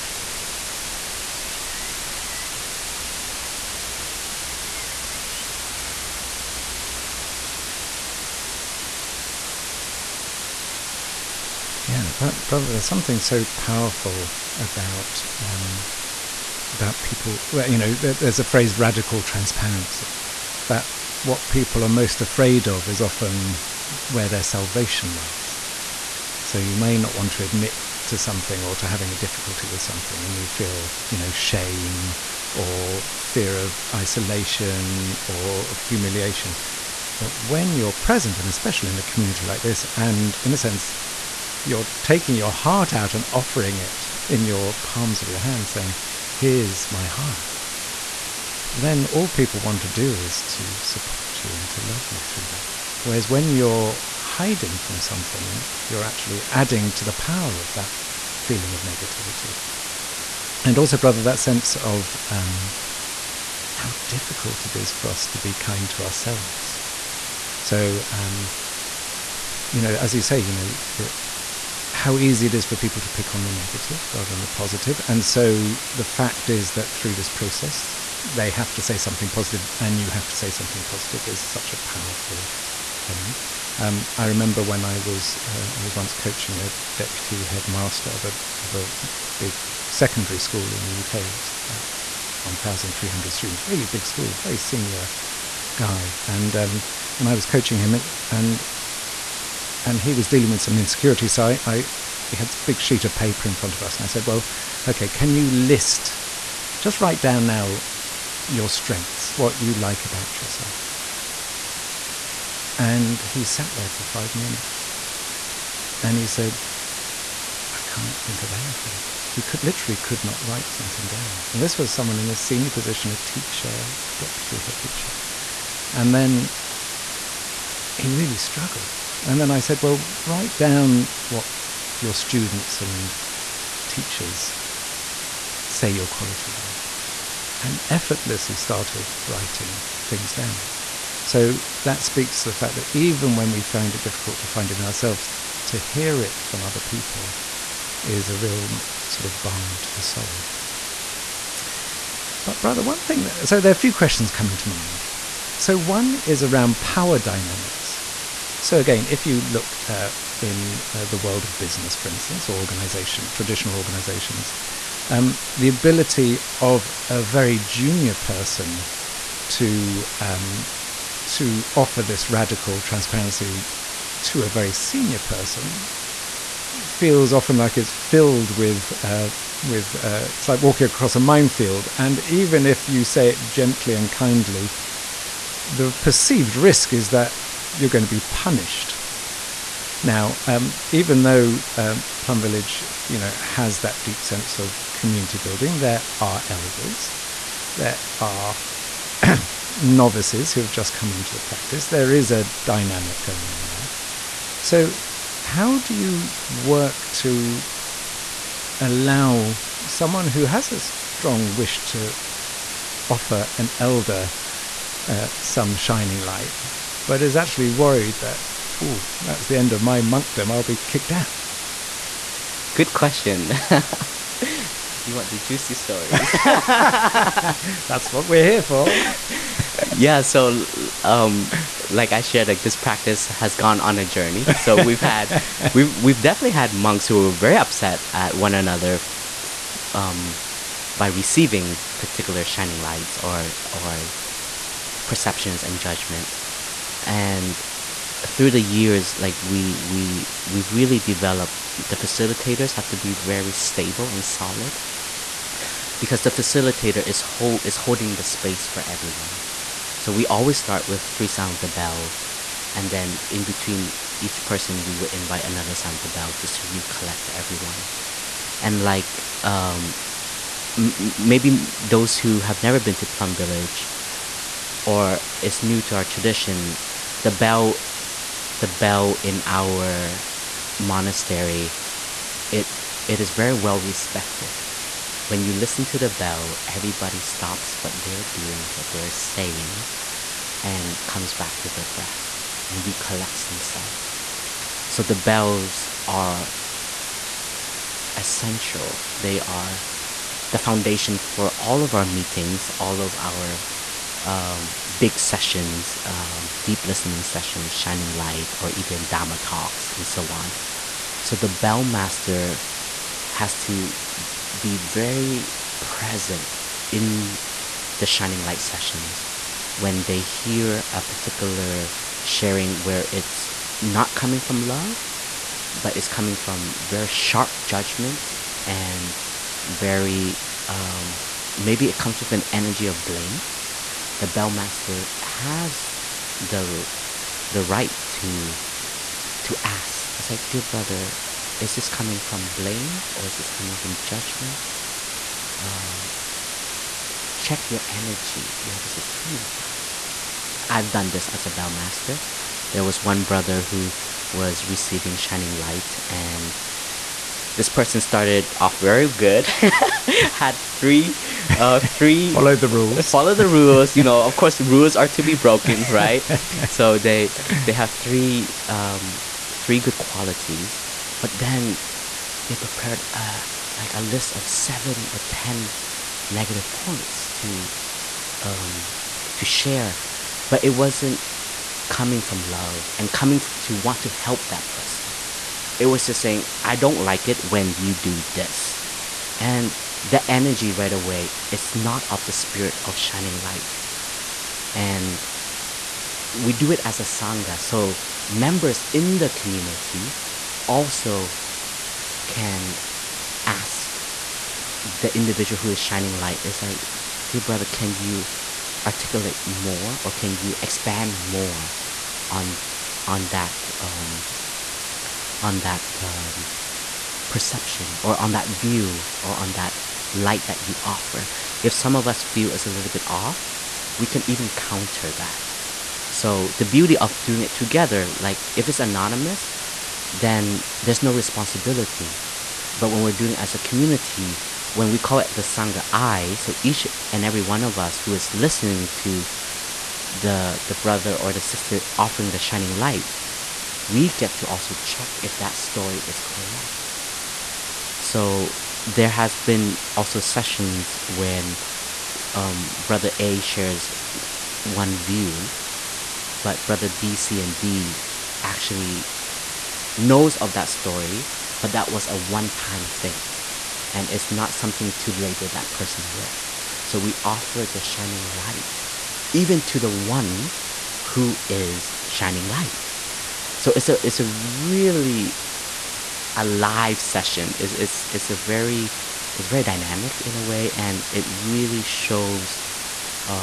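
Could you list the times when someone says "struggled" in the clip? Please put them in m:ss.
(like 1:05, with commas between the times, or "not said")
2:08.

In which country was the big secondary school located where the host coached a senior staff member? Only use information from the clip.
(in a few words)
UK.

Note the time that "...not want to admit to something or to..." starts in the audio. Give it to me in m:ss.
0:26.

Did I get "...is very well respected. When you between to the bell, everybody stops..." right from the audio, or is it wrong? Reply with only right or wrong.
wrong.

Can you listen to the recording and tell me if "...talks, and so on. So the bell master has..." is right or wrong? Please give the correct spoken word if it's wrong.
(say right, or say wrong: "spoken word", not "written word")
right.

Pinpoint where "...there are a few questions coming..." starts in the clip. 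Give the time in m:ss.
2:33.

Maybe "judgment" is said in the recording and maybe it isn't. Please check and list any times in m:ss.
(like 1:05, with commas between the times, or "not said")
4:05, 5:27, 5:44.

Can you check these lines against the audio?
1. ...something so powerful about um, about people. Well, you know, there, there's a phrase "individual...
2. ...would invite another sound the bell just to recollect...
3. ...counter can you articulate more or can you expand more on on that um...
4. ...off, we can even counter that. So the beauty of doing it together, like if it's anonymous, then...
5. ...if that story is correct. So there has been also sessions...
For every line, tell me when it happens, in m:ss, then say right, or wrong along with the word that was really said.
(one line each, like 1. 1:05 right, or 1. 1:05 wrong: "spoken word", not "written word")
1. 0:12 wrong: "radical", not "individual"
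2. 4:24 right
3. 6:47 wrong: "brother", not "counter"
4. 7:03 right
5. 7:25 right.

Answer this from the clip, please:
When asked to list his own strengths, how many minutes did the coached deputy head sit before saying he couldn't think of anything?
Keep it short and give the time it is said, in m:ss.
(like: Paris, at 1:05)
5, at 1:54.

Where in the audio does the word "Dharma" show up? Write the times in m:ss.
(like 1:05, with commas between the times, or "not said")
5:09.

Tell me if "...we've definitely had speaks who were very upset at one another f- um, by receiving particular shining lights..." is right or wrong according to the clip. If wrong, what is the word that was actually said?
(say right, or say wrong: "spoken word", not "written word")
wrong: "monks", not "speaks".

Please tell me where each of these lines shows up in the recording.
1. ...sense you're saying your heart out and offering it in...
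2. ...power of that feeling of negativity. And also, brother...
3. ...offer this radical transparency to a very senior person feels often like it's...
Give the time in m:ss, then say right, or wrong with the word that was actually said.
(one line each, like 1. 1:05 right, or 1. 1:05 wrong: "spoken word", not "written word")
1. 0:40 wrong: "taking", not "saying"
2. 0:57 right
3. 2:51 right.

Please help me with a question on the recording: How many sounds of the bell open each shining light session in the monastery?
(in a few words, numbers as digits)
3.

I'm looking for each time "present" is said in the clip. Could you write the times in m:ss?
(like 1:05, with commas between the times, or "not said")
0:37, 5:15.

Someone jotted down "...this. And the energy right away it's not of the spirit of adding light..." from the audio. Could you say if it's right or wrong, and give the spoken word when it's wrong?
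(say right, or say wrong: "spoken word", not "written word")
wrong: "shining", not "adding".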